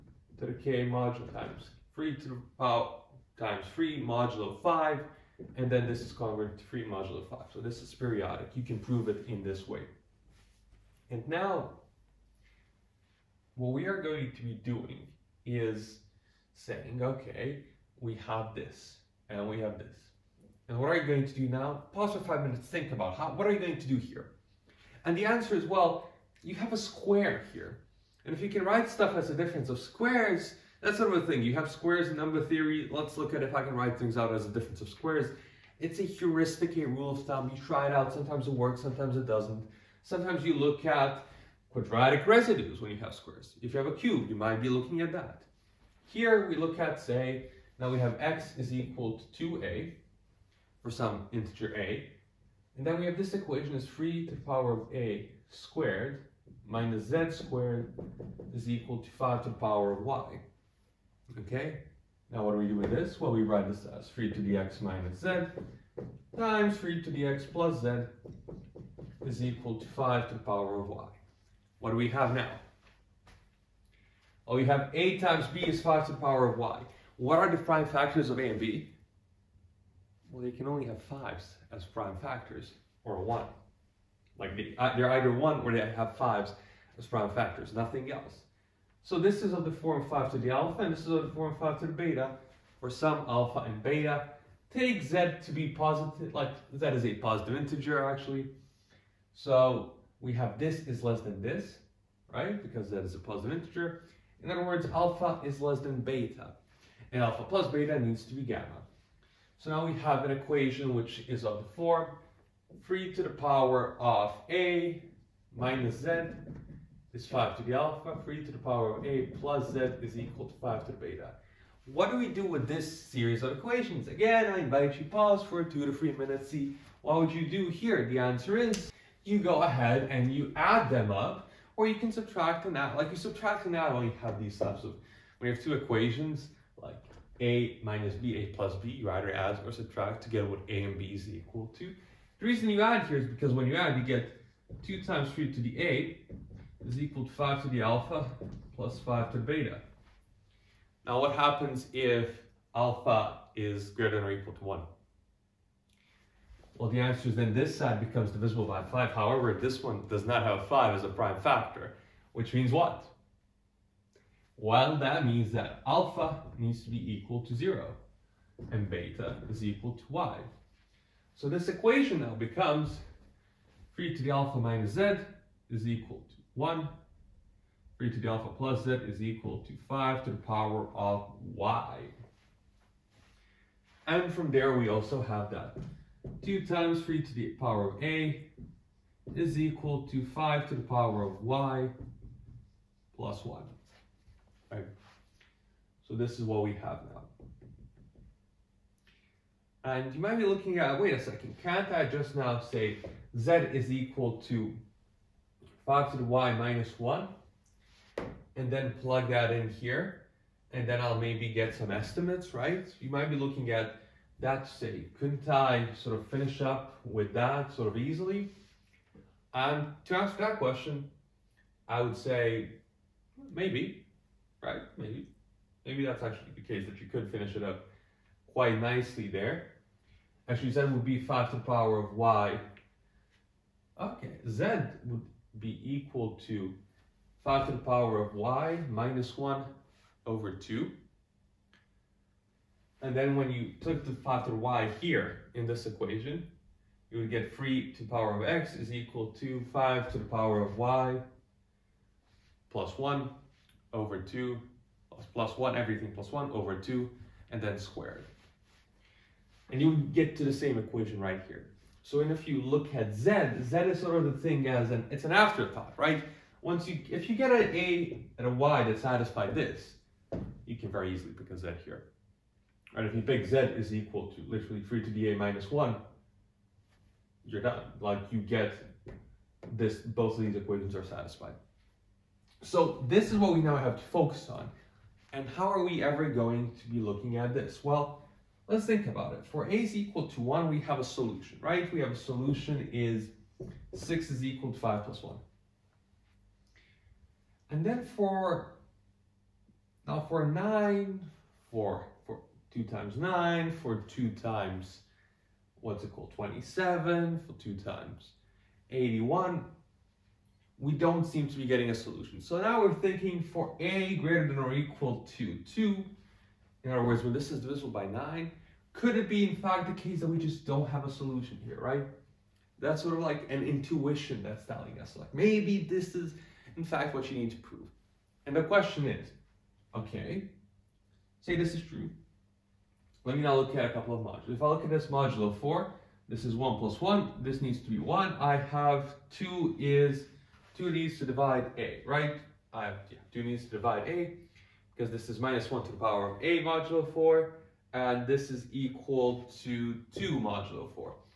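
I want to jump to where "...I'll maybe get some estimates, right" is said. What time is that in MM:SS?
03:31.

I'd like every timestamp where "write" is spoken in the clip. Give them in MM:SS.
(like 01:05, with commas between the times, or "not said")
00:28, 00:33, 01:03.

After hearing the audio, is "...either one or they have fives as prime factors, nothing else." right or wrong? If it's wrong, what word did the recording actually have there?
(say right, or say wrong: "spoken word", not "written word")
right.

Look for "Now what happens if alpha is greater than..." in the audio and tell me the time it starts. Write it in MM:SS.
02:31.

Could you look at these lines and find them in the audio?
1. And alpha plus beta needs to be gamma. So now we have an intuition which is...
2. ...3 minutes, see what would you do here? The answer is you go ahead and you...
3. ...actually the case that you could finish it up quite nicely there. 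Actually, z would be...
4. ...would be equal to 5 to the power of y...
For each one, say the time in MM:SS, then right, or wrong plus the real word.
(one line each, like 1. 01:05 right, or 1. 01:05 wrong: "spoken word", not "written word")
1. 01:47 wrong: "equation", not "intuition"
2. 02:05 right
3. 03:46 right
4. 03:55 right.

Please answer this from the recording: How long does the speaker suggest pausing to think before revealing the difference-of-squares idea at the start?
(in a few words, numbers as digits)
five minutes.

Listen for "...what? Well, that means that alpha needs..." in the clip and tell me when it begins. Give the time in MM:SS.
02:42.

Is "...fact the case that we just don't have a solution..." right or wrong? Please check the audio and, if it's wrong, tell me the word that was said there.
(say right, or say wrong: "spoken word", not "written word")
right.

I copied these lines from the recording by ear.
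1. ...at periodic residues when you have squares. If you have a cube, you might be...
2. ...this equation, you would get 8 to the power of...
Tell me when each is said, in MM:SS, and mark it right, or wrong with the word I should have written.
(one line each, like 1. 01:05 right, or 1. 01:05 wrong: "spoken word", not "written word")
1. 00:40 wrong: "quadratic", not "periodic"
2. 04:05 wrong: "3", not "8".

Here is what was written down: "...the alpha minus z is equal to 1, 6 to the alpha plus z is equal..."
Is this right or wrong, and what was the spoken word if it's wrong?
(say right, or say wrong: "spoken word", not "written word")
wrong: "3", not "6".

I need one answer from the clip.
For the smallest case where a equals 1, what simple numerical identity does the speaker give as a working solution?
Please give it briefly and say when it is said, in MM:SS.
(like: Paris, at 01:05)
6 = 5 + 1, at 04:53.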